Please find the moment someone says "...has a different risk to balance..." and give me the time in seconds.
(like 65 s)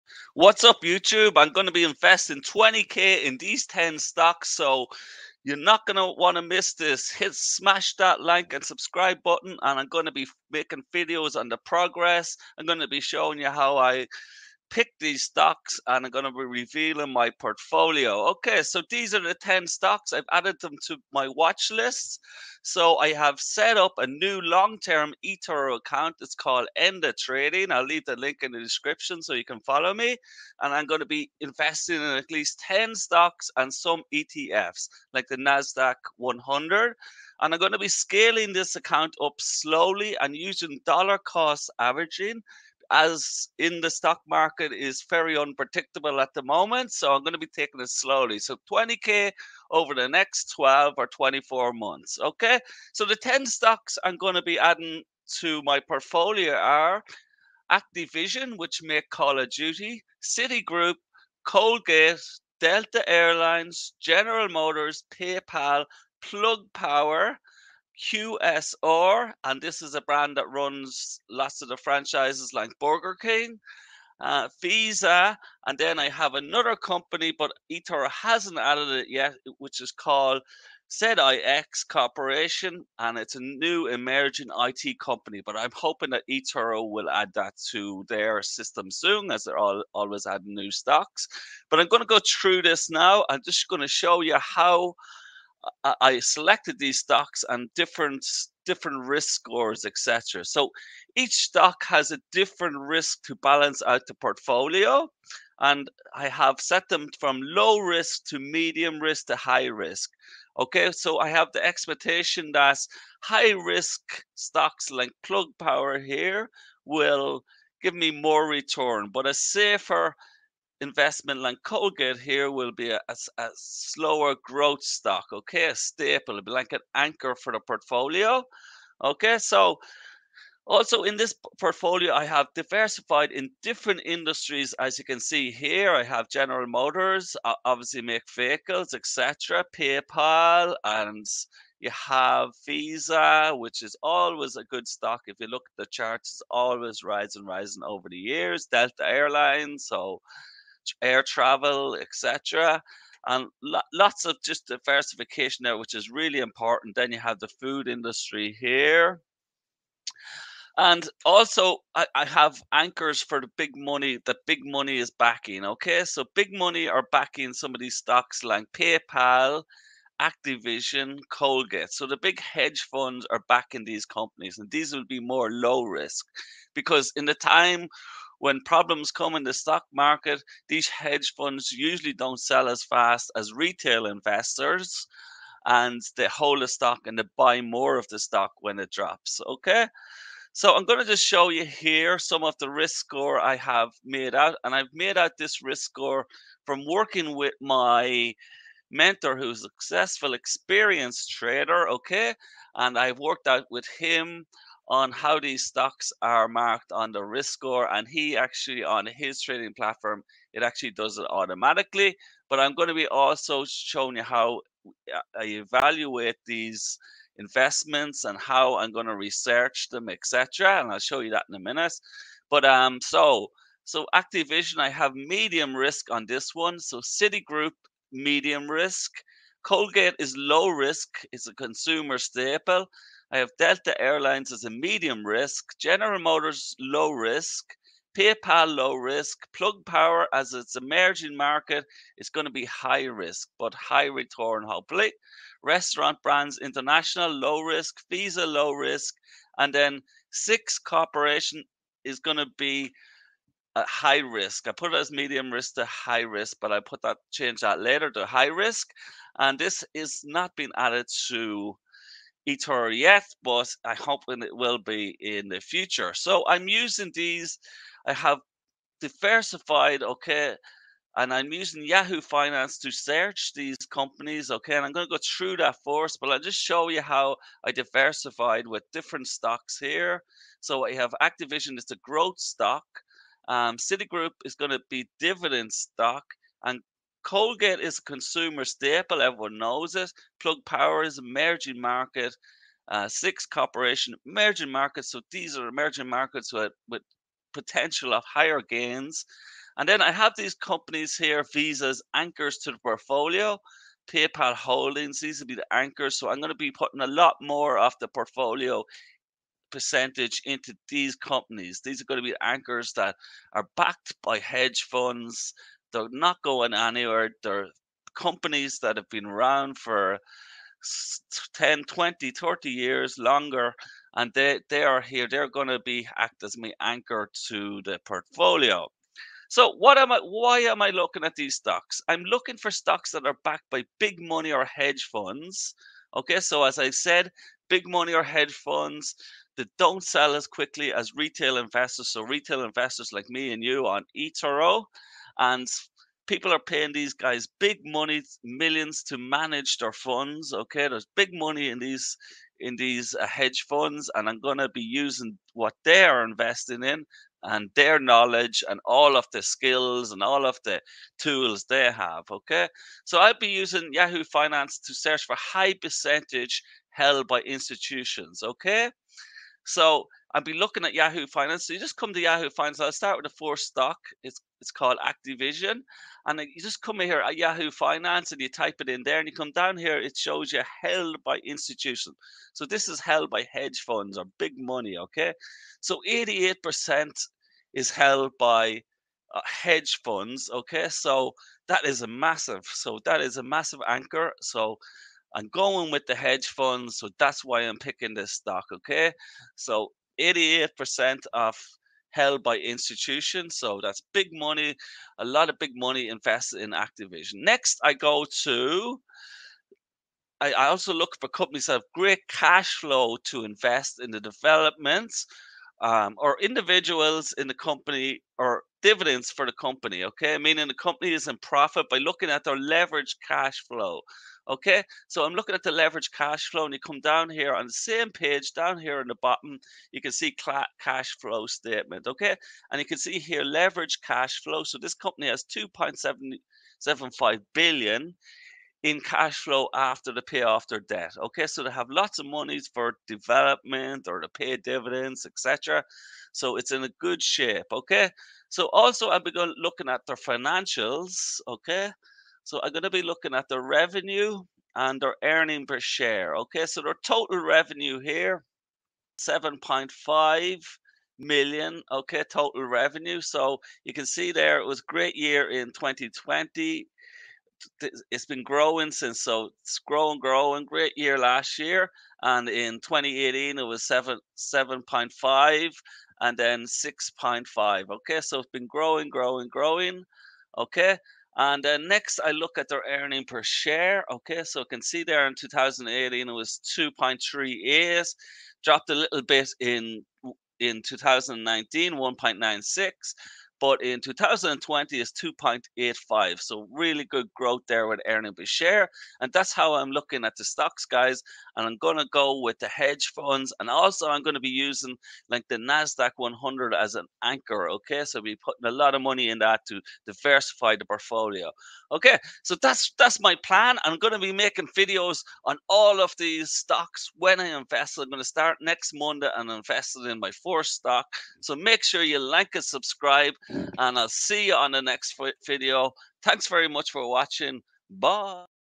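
101 s.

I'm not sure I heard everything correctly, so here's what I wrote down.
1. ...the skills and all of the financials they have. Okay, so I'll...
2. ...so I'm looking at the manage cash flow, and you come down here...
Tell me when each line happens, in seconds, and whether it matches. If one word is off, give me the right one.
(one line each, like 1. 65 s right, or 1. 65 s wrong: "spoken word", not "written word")
1. 359 s wrong: "tools", not "financials"
2. 425 s wrong: "leverage", not "manage".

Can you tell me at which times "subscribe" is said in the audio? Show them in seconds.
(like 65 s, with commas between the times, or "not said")
8 s, 522 s.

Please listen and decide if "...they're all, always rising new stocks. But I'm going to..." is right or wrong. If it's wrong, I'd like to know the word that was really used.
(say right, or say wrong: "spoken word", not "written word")
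wrong: "adding", not "rising".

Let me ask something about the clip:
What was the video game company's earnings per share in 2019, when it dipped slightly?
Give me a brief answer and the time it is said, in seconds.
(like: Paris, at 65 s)
1.96, at 491 s.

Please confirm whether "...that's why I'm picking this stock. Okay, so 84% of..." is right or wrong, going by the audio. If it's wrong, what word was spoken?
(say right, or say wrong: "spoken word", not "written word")
wrong: "88", not "84".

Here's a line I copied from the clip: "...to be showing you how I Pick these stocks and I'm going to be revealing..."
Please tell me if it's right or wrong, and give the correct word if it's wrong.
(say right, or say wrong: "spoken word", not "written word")
right.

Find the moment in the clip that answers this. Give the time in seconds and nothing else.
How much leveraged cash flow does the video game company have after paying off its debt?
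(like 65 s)
435 s.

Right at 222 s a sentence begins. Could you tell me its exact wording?
But um, so so Activision, I have medium risk on this one.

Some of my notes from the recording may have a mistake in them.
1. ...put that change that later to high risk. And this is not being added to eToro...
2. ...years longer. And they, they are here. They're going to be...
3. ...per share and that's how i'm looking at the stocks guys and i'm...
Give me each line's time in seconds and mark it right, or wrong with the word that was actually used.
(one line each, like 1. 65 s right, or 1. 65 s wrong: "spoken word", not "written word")
1. 256 s right
2. 322 s right
3. 498 s right.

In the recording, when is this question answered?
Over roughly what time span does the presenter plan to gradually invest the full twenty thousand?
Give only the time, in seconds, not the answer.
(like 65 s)
50 s.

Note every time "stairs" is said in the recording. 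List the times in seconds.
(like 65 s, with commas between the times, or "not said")
not said.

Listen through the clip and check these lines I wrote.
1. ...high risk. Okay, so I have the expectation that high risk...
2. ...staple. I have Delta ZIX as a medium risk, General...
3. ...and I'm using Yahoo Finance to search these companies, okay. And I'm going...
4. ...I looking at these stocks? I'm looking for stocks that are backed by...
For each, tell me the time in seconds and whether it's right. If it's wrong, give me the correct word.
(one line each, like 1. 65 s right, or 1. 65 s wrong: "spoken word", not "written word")
1. 109 s right
2. 232 s wrong: "Airlines", not "ZIX"
3. 271 s right
4. 330 s right.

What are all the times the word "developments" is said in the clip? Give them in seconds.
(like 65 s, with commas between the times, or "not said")
414 s, 443 s.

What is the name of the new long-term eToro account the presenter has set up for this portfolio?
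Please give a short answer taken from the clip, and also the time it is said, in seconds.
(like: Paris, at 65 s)
Enda Trading, at 26 s.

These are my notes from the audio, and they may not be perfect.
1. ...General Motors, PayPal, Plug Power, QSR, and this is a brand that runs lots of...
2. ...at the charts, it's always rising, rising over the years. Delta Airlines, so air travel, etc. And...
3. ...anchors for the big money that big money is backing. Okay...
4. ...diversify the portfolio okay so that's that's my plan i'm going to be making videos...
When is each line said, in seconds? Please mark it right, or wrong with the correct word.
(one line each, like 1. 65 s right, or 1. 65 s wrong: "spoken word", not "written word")
1. 64 s right
2. 145 s right
3. 162 s right
4. 510 s right.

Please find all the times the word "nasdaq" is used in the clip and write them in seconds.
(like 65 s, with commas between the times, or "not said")
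35 s, 505 s.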